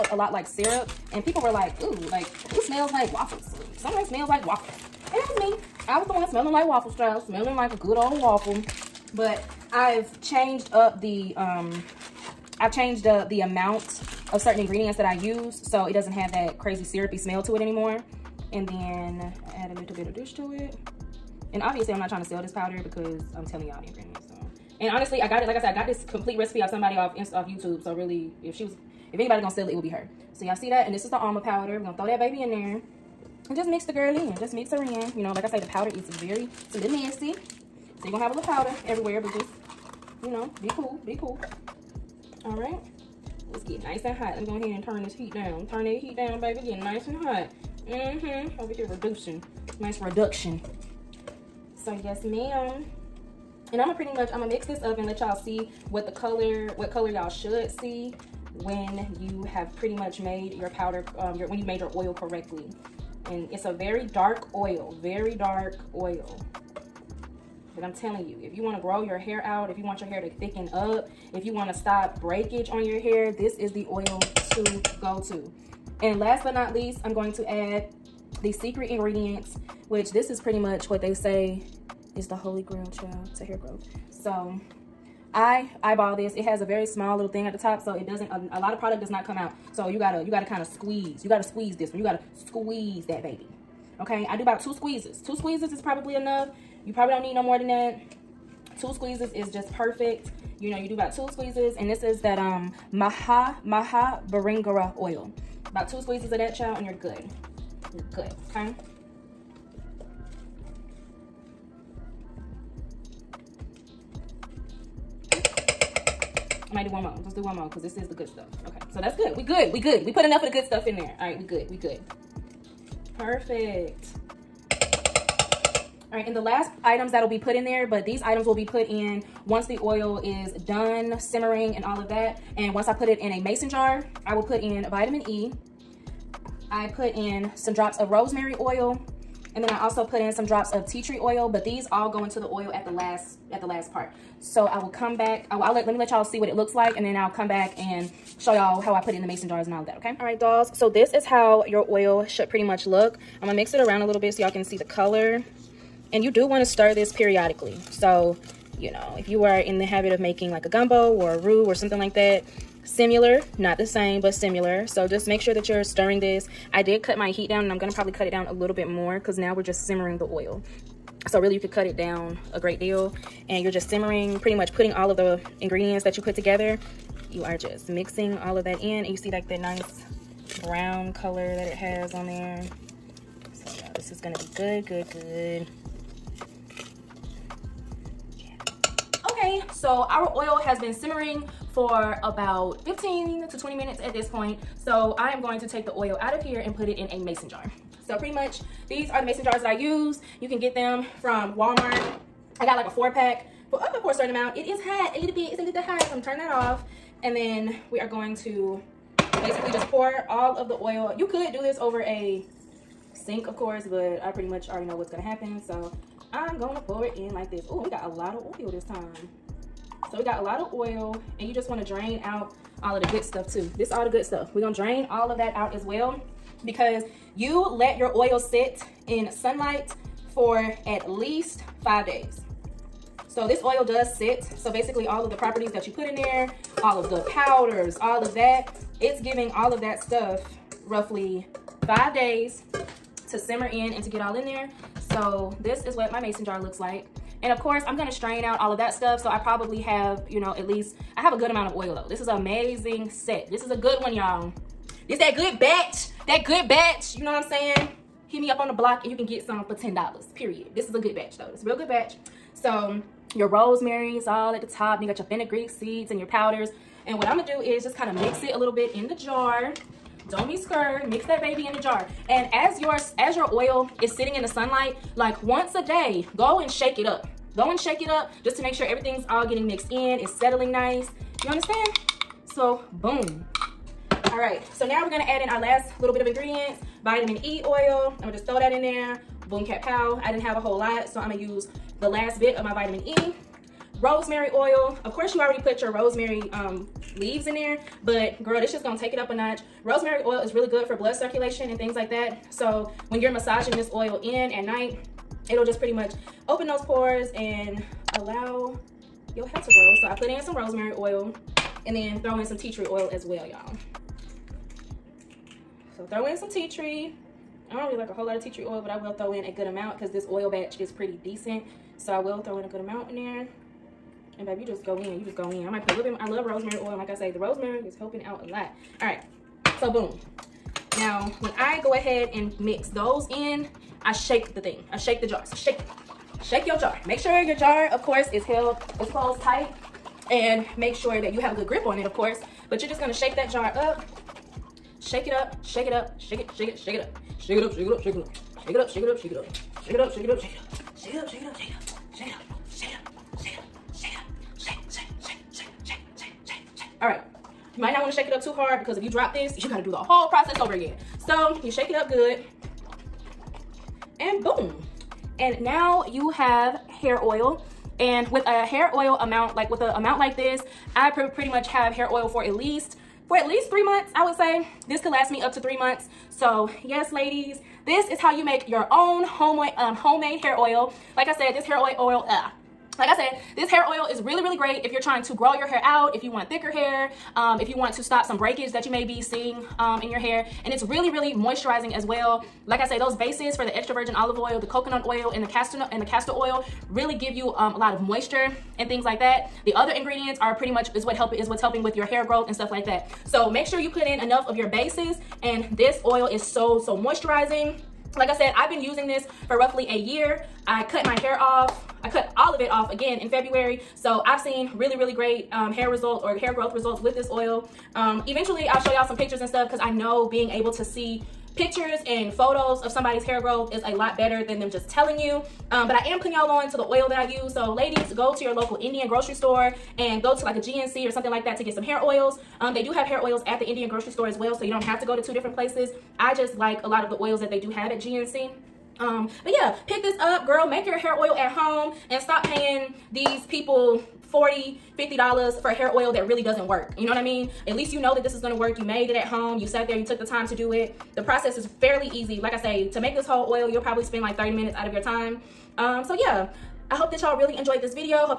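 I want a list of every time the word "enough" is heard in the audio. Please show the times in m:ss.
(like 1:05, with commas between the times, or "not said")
1:36, 2:00, 6:44.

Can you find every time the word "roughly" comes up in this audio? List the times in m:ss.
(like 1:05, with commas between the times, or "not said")
4:00, 6:49.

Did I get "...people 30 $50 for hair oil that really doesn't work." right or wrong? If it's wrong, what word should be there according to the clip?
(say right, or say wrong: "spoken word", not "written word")
wrong: "40", not "30".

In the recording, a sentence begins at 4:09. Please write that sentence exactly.
So I probably have, you know, at least, I have a good amount of oil though.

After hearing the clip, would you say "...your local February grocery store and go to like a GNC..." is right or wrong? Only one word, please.
wrong.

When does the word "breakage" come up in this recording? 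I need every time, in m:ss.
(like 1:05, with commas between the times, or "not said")
1:12, 6:28.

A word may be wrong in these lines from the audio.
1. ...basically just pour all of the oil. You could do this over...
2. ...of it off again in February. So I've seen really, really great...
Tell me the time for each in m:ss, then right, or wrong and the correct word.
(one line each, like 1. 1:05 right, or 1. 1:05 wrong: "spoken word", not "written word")
1. 3:29 right
2. 6:52 right.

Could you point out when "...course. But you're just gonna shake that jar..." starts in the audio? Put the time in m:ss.
5:42.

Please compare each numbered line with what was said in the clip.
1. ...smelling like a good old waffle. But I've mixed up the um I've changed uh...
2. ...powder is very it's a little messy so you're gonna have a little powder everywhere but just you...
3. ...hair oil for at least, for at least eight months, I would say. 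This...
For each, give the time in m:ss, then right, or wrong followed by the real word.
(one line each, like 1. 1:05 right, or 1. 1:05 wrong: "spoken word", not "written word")
1. 0:07 wrong: "changed", not "mixed"
2. 0:35 right
3. 6:11 wrong: "three", not "eight".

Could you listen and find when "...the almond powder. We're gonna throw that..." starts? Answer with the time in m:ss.
0:31.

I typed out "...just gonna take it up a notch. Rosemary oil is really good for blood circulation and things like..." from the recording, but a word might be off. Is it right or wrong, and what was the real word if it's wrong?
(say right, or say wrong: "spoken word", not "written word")
right.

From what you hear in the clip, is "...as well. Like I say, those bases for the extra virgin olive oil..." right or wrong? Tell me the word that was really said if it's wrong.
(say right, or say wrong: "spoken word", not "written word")
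right.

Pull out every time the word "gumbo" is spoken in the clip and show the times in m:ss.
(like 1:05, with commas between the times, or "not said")
2:40.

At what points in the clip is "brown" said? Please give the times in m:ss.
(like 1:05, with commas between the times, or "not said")
3:00.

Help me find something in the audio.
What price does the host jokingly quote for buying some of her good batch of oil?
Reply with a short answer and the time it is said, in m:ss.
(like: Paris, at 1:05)
$10, at 4:19.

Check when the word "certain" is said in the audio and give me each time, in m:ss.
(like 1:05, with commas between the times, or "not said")
0:14, 3:24.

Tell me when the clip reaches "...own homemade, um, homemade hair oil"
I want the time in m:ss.
6:18.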